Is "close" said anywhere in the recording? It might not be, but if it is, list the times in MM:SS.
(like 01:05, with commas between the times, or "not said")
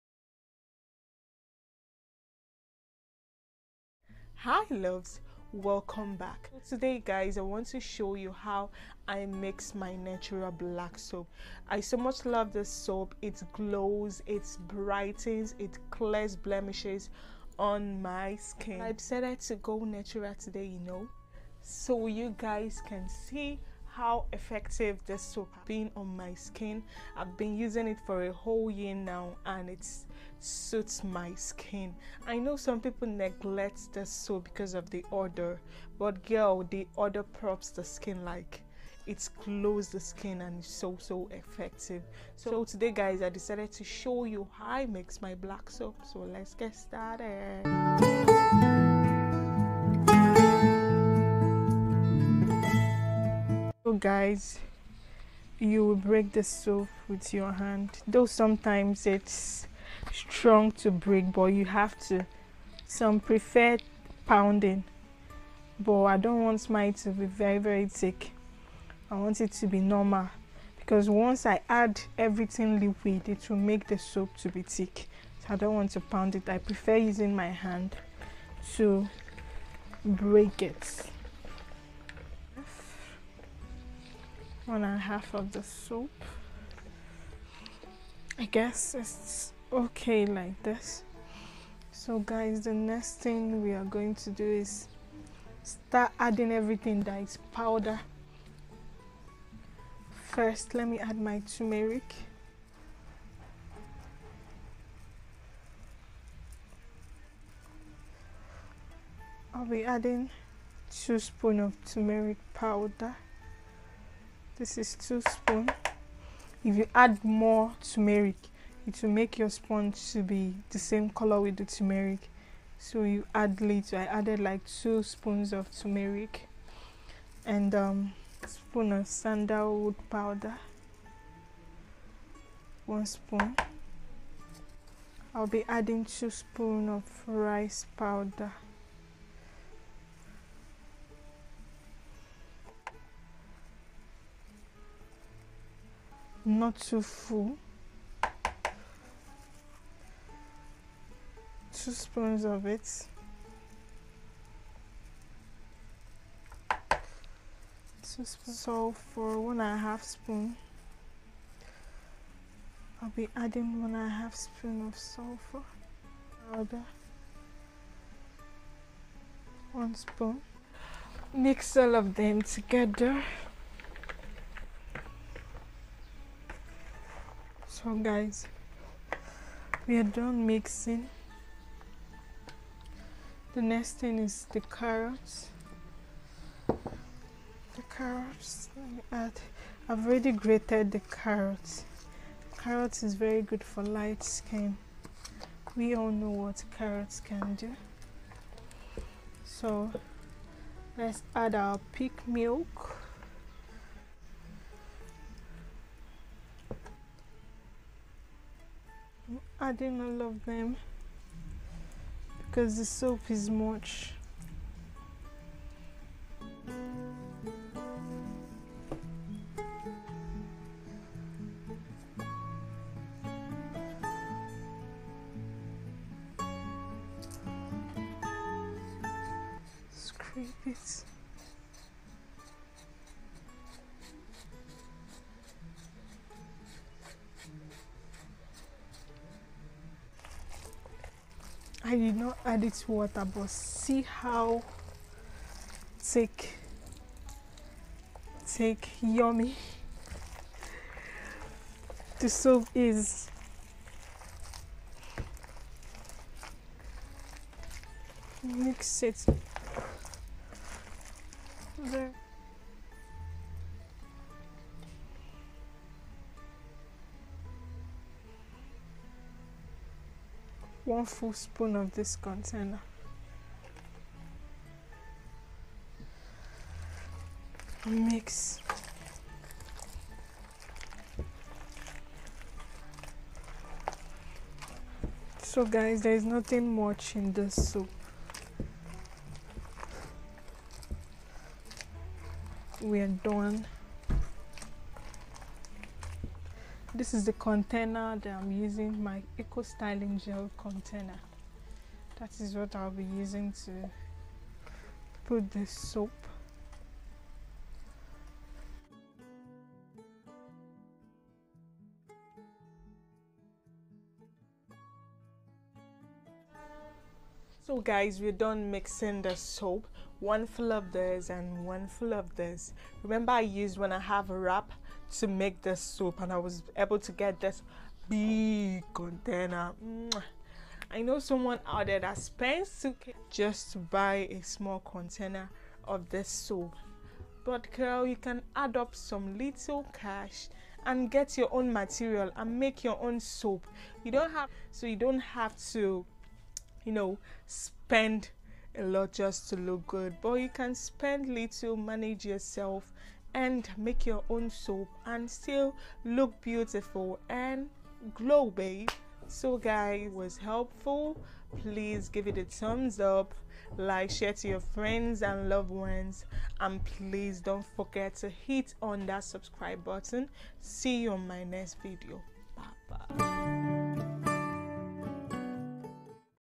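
00:39.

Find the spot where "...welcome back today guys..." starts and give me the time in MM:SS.
00:05.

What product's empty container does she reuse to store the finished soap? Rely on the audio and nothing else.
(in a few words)
Eco styling gel.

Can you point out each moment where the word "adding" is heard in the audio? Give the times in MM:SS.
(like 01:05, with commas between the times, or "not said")
01:36, 01:49, 02:15, 02:43, 03:29.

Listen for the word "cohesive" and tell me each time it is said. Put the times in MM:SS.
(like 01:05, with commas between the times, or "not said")
not said.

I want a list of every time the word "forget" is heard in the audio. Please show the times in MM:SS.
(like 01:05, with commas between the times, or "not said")
06:07.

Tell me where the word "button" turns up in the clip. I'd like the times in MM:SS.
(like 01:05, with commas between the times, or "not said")
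06:09.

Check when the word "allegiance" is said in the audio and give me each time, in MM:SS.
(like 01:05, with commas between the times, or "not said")
not said.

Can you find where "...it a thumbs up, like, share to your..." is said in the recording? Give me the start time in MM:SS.
06:02.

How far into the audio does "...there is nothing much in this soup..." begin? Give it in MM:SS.
04:46.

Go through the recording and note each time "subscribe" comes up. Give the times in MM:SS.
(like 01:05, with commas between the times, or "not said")
06:09.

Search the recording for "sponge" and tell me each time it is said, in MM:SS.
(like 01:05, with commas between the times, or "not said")
01:59.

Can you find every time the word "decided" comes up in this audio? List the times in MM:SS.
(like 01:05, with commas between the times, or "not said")
00:18, 00:43.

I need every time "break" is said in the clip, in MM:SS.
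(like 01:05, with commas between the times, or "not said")
00:55, 01:00, 01:20.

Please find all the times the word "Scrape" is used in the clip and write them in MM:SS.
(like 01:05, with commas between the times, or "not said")
03:49.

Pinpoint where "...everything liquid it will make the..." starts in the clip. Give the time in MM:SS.
01:12.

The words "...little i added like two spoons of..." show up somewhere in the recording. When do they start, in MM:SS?
02:03.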